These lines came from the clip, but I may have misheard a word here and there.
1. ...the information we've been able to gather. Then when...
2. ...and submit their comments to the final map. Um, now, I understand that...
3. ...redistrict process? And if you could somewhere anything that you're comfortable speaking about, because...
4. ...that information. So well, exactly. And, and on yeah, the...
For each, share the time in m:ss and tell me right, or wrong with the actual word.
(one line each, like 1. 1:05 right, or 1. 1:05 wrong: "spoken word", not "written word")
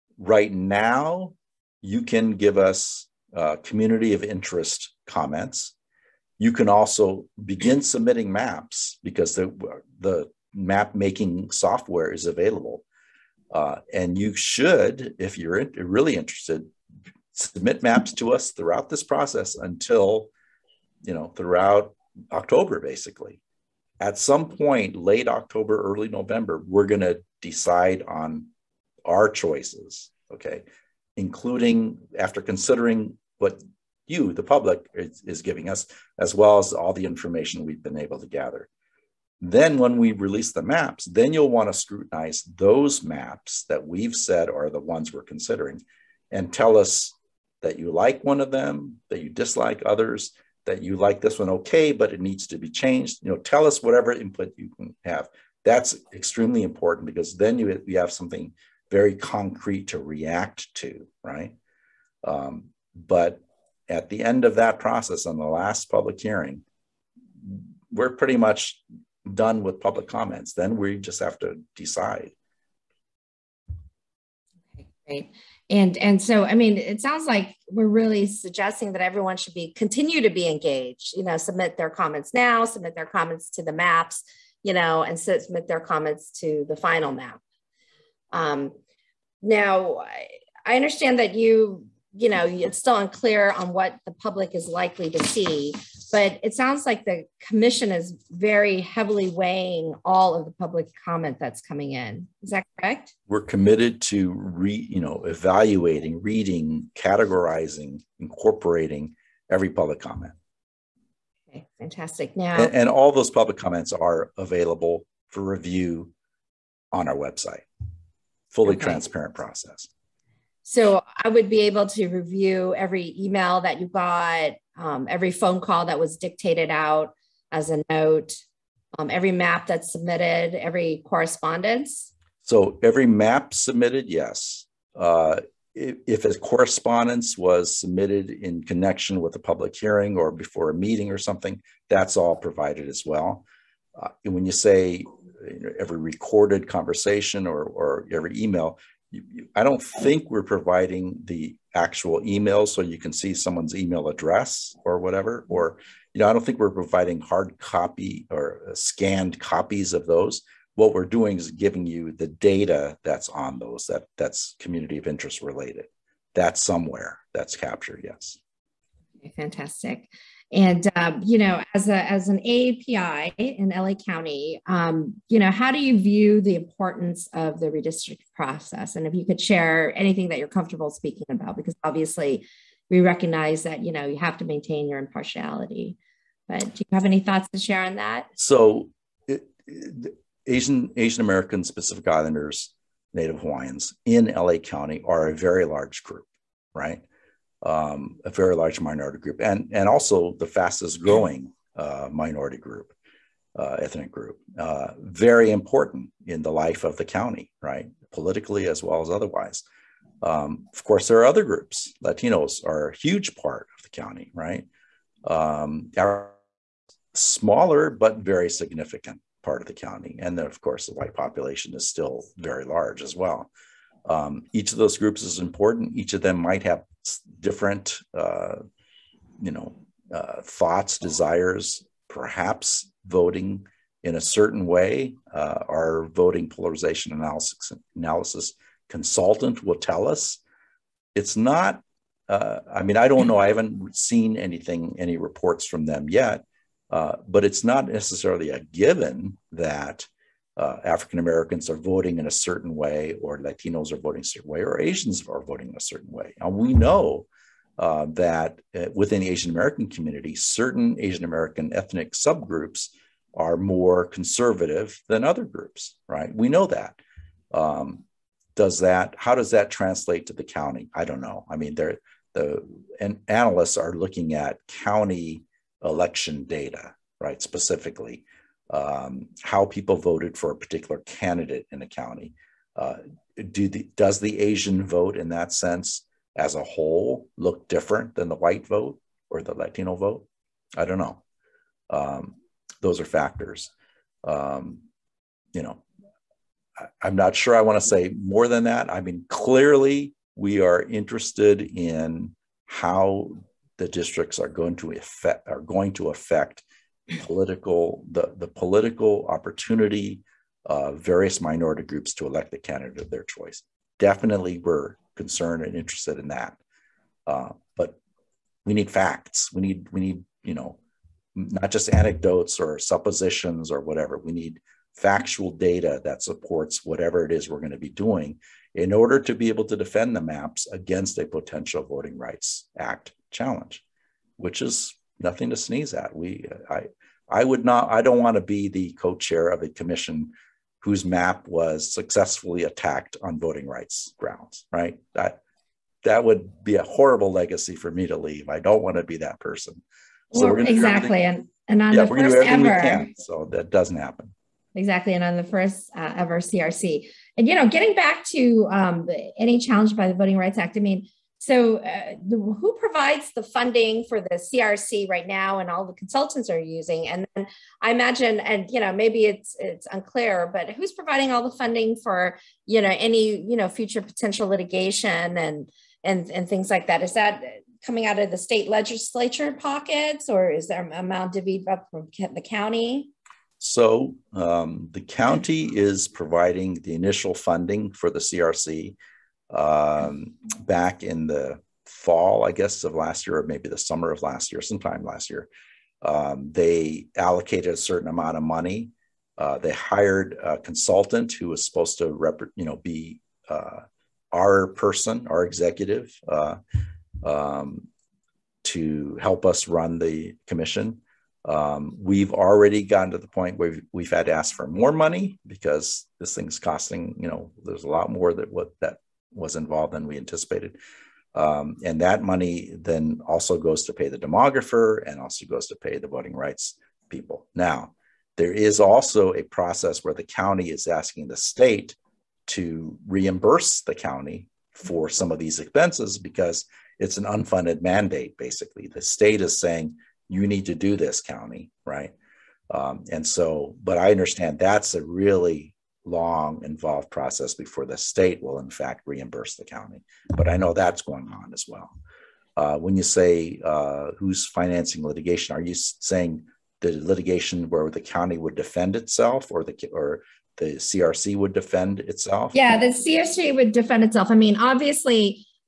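1. 0:36 right
2. 1:25 right
3. 2:57 wrong: "share", not "somewhere"
4. 5:49 wrong: "person", not "information".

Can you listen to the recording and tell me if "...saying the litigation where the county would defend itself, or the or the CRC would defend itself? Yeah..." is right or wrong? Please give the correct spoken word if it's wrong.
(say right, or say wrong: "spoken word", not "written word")
right.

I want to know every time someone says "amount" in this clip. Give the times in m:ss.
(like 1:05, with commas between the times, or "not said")
6:20, 6:38.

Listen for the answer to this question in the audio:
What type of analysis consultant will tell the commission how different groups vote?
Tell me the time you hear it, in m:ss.
3:56.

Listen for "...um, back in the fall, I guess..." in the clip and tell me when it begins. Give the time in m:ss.
6:29.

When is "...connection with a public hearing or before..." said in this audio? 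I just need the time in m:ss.
2:18.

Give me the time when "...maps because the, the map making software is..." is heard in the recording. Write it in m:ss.
0:08.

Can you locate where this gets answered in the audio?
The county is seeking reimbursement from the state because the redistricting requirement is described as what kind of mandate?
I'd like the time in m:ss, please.
7:17.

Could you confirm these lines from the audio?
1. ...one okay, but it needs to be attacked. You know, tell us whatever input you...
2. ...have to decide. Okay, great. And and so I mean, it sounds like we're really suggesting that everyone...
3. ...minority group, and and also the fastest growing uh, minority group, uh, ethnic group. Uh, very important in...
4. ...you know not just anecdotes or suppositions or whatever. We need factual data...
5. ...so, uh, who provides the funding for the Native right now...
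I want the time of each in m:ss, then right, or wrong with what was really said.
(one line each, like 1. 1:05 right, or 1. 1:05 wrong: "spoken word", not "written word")
1. 0:51 wrong: "changed", not "attacked"
2. 1:11 right
3. 3:18 right
4. 5:20 right
5. 6:01 wrong: "CRC", not "Native".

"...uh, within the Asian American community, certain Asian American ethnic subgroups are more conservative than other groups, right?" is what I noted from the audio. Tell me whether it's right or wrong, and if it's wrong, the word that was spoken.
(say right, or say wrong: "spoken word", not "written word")
right.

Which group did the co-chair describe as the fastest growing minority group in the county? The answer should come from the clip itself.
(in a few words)
Asian American Pacific Islanders.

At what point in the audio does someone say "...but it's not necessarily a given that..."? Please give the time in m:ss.
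4:07.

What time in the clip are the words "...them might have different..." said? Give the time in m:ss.
3:46.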